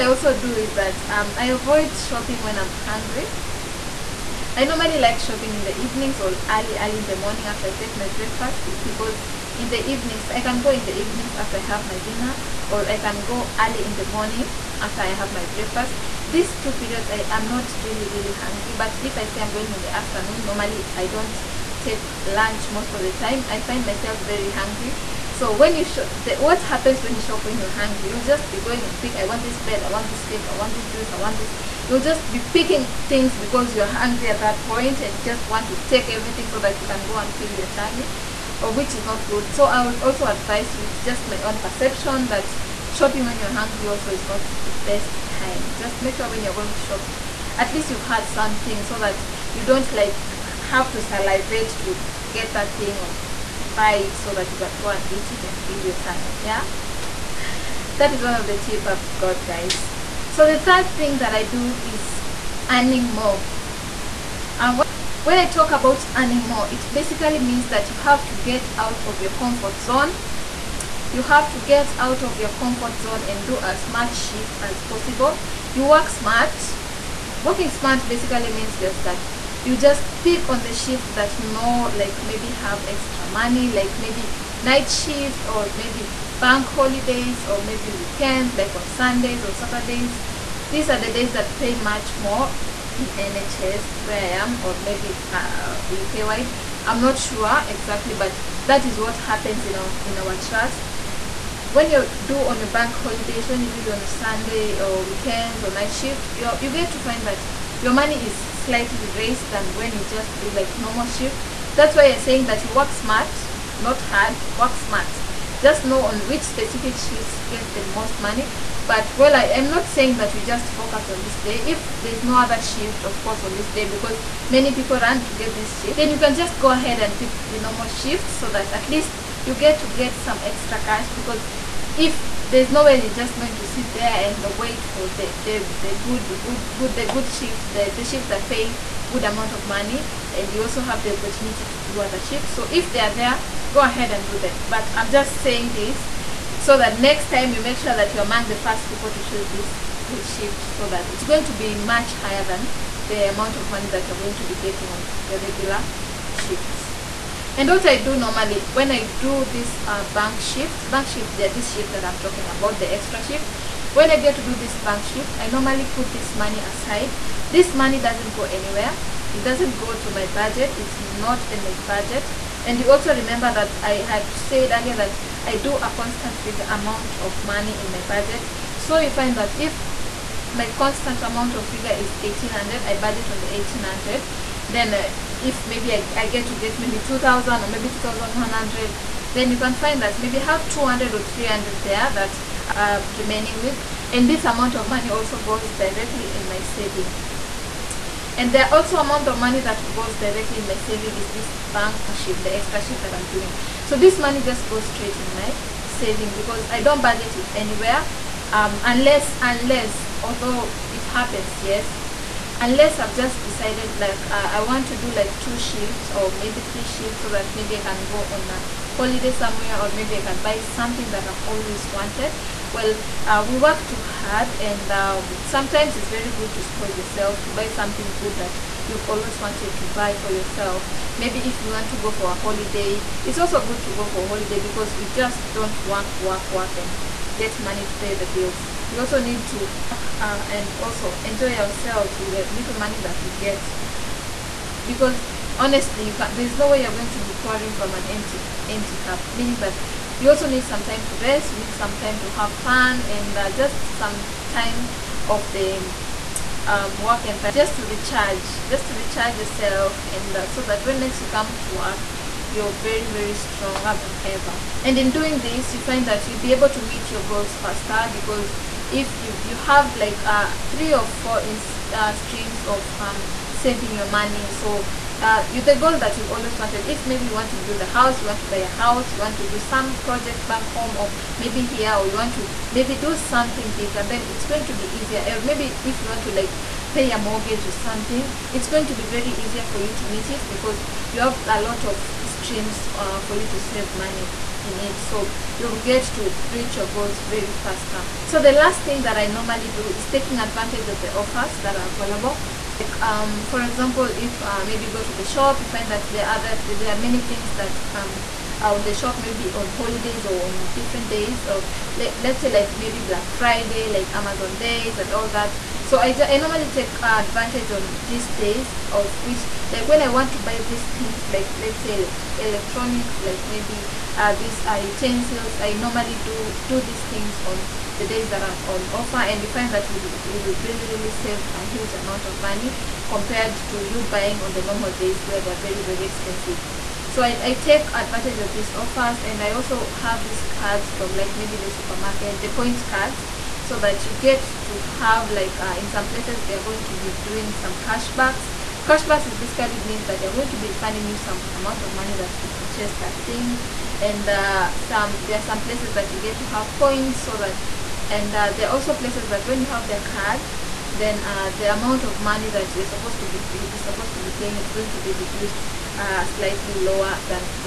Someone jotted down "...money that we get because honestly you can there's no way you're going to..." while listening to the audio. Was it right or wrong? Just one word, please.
right.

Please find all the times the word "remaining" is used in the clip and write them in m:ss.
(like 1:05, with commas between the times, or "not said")
3:13.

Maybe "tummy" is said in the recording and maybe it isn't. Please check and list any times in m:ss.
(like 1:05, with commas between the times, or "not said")
0:37, 0:55.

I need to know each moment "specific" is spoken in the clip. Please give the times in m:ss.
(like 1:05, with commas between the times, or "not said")
1:56.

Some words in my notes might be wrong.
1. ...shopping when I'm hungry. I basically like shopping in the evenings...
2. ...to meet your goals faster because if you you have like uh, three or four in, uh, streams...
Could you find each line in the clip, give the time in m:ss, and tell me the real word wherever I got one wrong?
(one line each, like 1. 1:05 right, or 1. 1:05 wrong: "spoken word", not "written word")
1. 0:01 wrong: "normally", not "basically"
2. 4:26 right.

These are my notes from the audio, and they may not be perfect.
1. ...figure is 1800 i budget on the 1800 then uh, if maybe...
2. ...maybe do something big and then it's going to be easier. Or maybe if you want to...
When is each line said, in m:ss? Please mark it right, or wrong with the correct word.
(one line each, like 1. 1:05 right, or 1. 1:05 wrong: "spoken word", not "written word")
1. 3:01 right
2. 4:42 right.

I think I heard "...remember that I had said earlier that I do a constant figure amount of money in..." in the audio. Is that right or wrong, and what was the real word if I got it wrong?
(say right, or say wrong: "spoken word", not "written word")
right.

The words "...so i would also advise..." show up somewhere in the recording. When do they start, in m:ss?
0:39.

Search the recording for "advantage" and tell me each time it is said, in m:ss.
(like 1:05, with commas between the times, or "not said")
5:00, 5:17, 5:37.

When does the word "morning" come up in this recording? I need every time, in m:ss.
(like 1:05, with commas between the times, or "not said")
0:07, 0:14.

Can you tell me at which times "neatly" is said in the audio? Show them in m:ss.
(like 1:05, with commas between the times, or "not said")
not said.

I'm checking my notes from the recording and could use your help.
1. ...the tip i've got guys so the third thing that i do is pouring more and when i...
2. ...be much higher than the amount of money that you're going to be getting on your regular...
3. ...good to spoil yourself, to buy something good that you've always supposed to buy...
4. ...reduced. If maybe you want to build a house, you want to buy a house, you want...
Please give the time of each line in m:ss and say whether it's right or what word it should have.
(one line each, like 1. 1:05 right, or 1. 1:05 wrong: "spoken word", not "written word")
1. 0:58 wrong: "earning", not "pouring"
2. 2:31 right
3. 3:46 wrong: "wanted", not "supposed"
4. 4:36 wrong: "wanted", not "reduced".